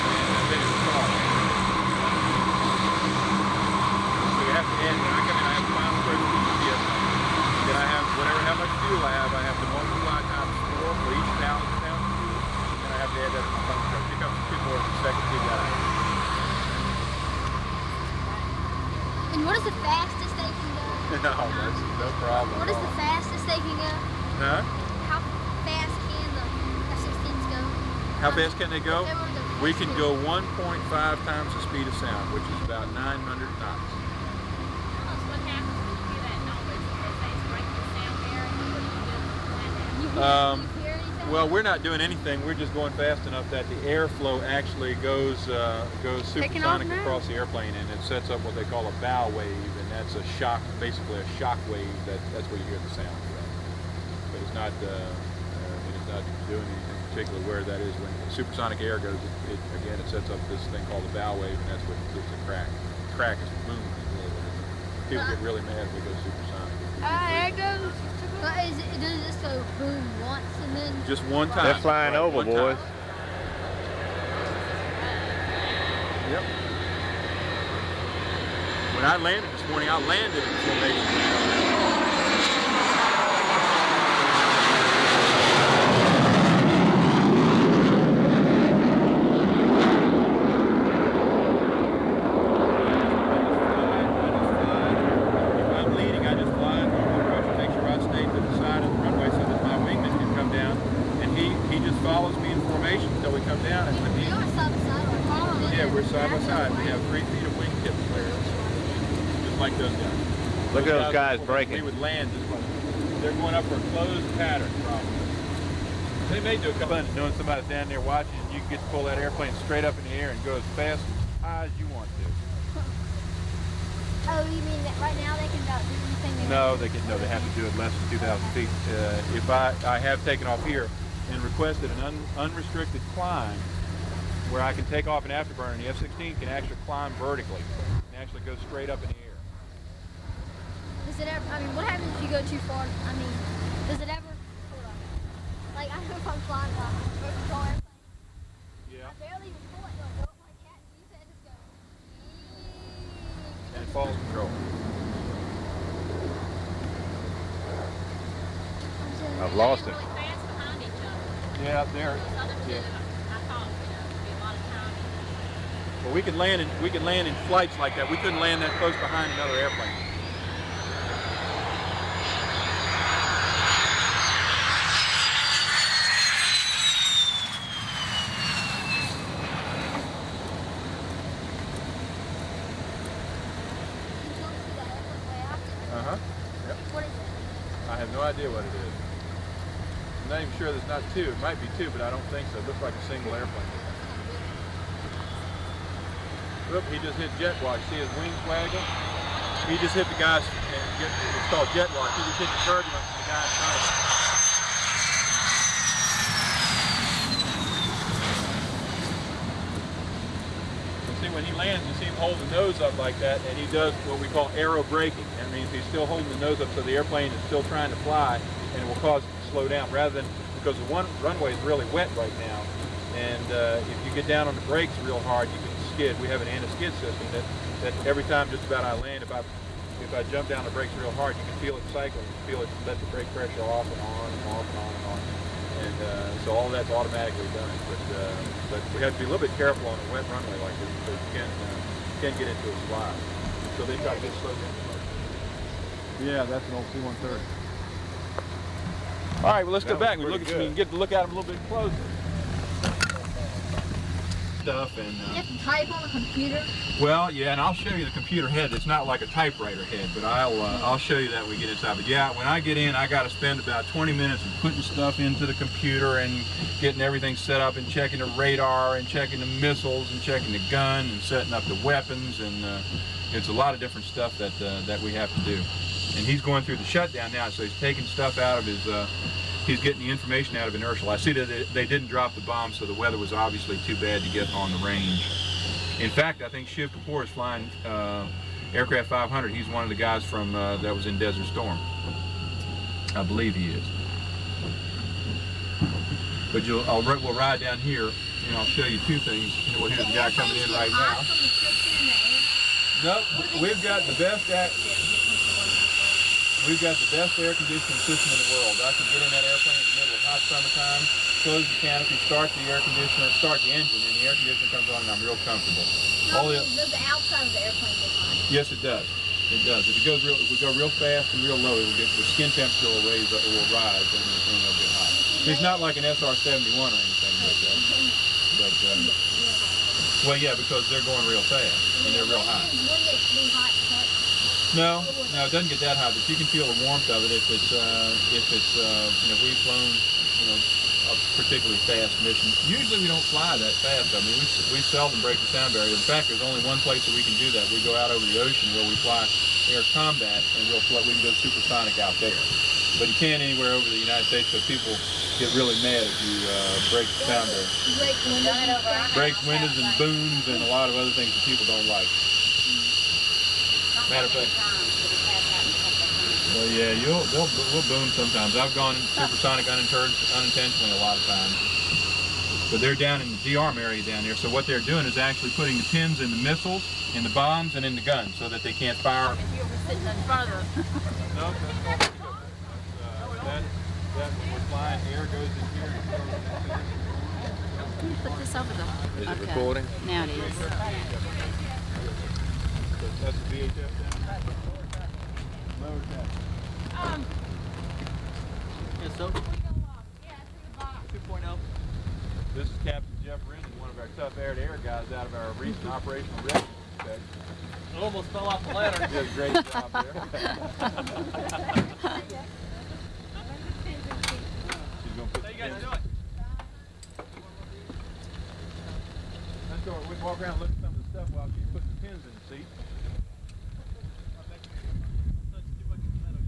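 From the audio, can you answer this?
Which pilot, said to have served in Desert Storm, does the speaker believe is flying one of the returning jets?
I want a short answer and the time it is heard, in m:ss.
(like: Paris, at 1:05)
Shiv Kapoor, at 4:46.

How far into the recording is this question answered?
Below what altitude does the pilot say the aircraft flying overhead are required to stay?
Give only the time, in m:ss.
2:08.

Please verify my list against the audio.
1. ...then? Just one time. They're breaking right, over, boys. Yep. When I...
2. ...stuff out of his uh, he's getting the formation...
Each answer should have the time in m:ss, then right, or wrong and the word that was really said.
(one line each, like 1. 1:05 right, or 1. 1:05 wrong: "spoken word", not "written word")
1. 1:10 wrong: "flying", not "breaking"
2. 4:38 wrong: "information", not "formation".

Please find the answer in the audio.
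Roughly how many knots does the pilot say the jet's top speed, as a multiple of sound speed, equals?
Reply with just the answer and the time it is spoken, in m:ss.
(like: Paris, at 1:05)
900 knots, at 0:32.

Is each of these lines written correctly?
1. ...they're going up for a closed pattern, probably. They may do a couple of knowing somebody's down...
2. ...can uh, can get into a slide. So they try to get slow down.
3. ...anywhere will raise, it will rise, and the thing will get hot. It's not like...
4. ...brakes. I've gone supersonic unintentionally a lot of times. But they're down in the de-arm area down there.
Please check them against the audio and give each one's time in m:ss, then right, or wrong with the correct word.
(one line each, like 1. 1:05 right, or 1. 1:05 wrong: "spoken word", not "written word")
1. 1:53 right
2. 4:01 right
3. 5:22 wrong: "temperature", not "anywhere"
4. 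6:08 wrong: "sometimes", not "brakes".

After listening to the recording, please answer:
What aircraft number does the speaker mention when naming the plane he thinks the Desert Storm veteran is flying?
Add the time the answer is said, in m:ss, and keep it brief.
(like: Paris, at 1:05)
500, at 4:48.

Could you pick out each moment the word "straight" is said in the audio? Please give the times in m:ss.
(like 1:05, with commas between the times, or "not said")
1:59, 2:18.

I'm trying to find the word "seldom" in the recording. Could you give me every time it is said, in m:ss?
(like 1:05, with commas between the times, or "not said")
5:44.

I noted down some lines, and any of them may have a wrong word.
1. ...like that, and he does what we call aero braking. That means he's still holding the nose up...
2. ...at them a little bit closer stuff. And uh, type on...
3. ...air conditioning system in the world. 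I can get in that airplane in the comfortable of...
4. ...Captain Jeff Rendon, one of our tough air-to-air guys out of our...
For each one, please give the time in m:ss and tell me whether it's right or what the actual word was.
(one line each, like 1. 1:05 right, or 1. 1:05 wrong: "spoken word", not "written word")
1. 3:32 right
2. 4:11 right
3. 5:07 wrong: "middle", not "comfortable"
4. 6:42 right.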